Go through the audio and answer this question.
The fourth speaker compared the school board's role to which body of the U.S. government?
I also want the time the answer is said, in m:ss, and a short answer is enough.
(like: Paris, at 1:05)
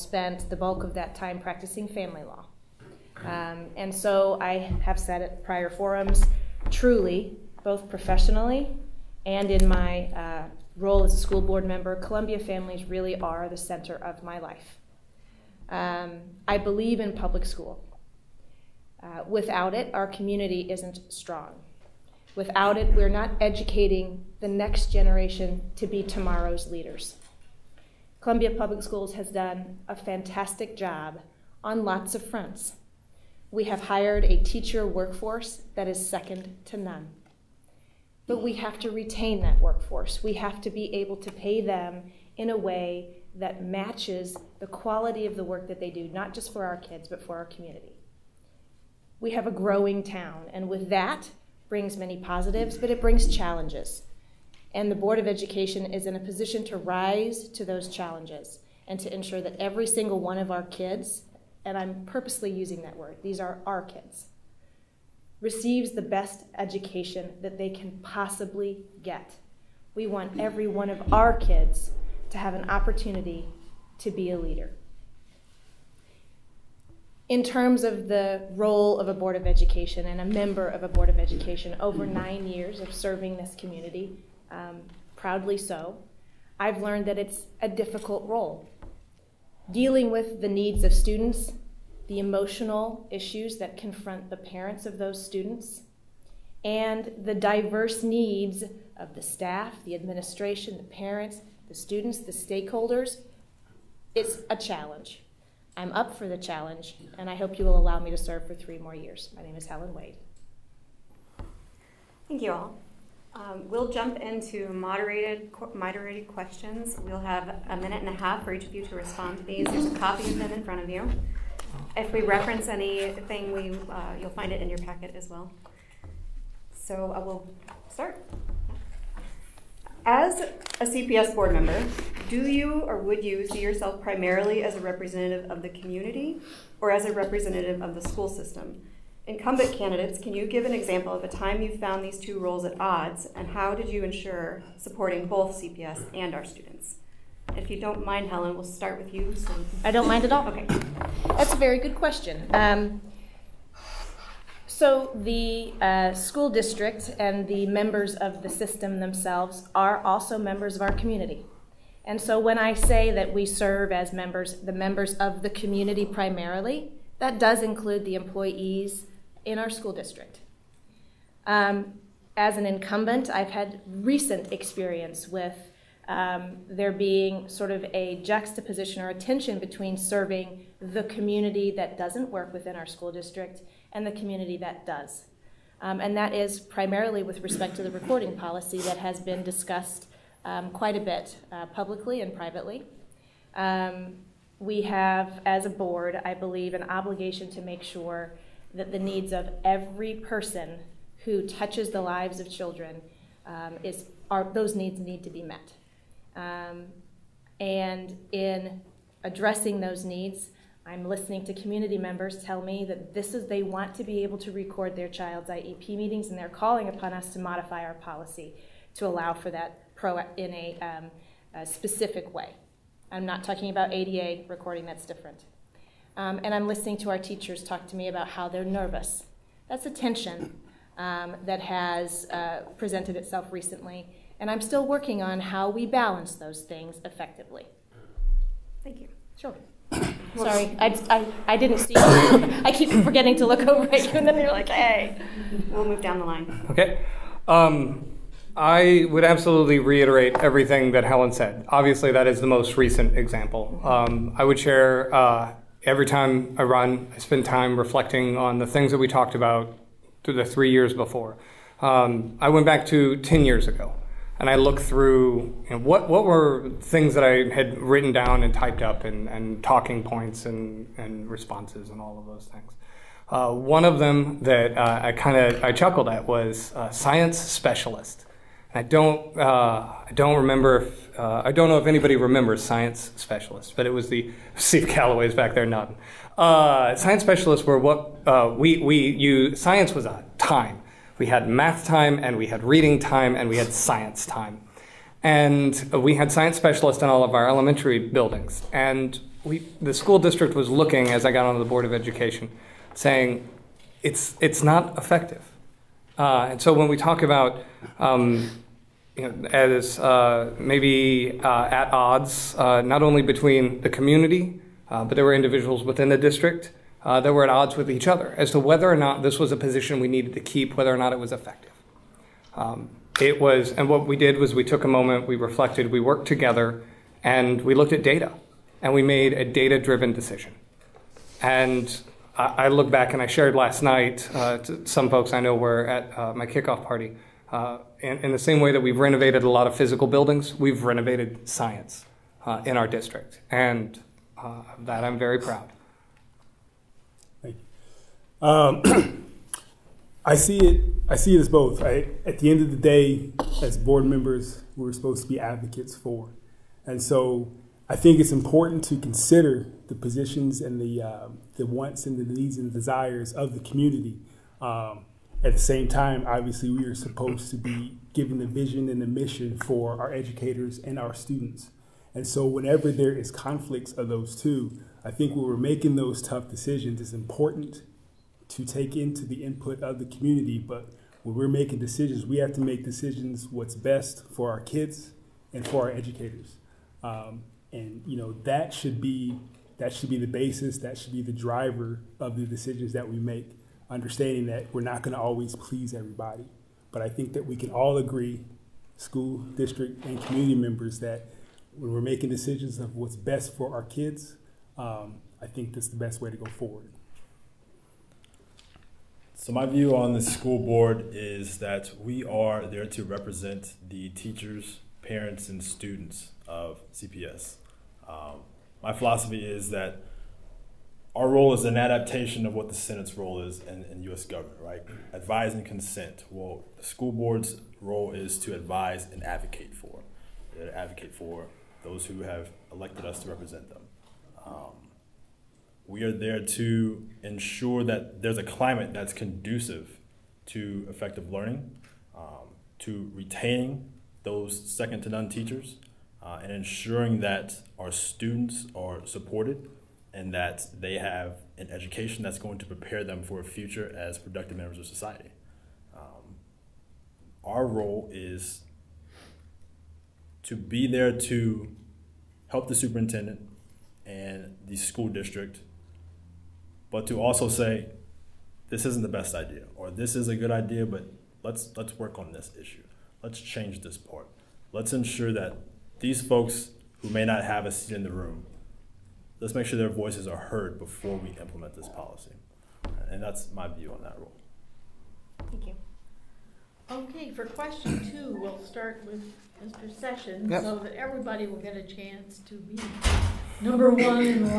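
the Senate, at 7:02.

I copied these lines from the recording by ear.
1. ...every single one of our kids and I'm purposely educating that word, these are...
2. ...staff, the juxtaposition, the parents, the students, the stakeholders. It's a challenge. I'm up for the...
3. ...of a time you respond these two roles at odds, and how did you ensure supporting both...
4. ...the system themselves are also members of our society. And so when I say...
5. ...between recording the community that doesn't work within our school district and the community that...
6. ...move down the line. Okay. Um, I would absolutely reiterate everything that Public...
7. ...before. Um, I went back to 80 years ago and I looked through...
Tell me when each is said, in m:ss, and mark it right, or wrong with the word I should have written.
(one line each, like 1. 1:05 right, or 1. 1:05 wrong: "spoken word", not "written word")
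1. 0:59 wrong: "using", not "educating"
2. 1:39 wrong: "administration", not "juxtaposition"
3. 2:21 wrong: "found", not "respond"
4. 2:38 wrong: "community", not "society"
5. 2:59 wrong: "serving", not "recording"
6. 4:05 wrong: "Helen", not "Public"
7. 4:20 wrong: "10", not "80".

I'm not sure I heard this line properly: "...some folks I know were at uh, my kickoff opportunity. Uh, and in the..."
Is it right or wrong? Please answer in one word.
wrong.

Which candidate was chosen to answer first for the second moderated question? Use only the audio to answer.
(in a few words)
Mr. Sessions.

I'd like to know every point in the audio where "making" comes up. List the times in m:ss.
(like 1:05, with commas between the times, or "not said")
6:15, 6:21, 6:42.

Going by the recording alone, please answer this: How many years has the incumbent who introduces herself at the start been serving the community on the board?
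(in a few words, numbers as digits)
9.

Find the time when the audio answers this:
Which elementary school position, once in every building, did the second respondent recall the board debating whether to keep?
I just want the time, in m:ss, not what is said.
4:36.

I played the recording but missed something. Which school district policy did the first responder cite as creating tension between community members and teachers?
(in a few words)
recording policy.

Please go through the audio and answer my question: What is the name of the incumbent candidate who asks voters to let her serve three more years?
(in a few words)
Helen Wade.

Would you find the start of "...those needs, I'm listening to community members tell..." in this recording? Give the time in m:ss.
3:29.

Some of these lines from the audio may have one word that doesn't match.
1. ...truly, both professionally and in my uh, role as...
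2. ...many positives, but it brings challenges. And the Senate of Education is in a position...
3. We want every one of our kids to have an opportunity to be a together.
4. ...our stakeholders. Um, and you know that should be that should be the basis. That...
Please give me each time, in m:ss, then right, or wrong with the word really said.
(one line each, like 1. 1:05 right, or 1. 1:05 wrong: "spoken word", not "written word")
1. 0:06 right
2. 0:51 wrong: "Board", not "Senate"
3. 1:09 wrong: "leader", not "together"
4. 6:25 wrong: "educators", not "stakeholders".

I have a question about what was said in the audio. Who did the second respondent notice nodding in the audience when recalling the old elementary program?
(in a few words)
Steve Calloway.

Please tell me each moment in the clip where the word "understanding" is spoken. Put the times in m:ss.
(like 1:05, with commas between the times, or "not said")
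6:33.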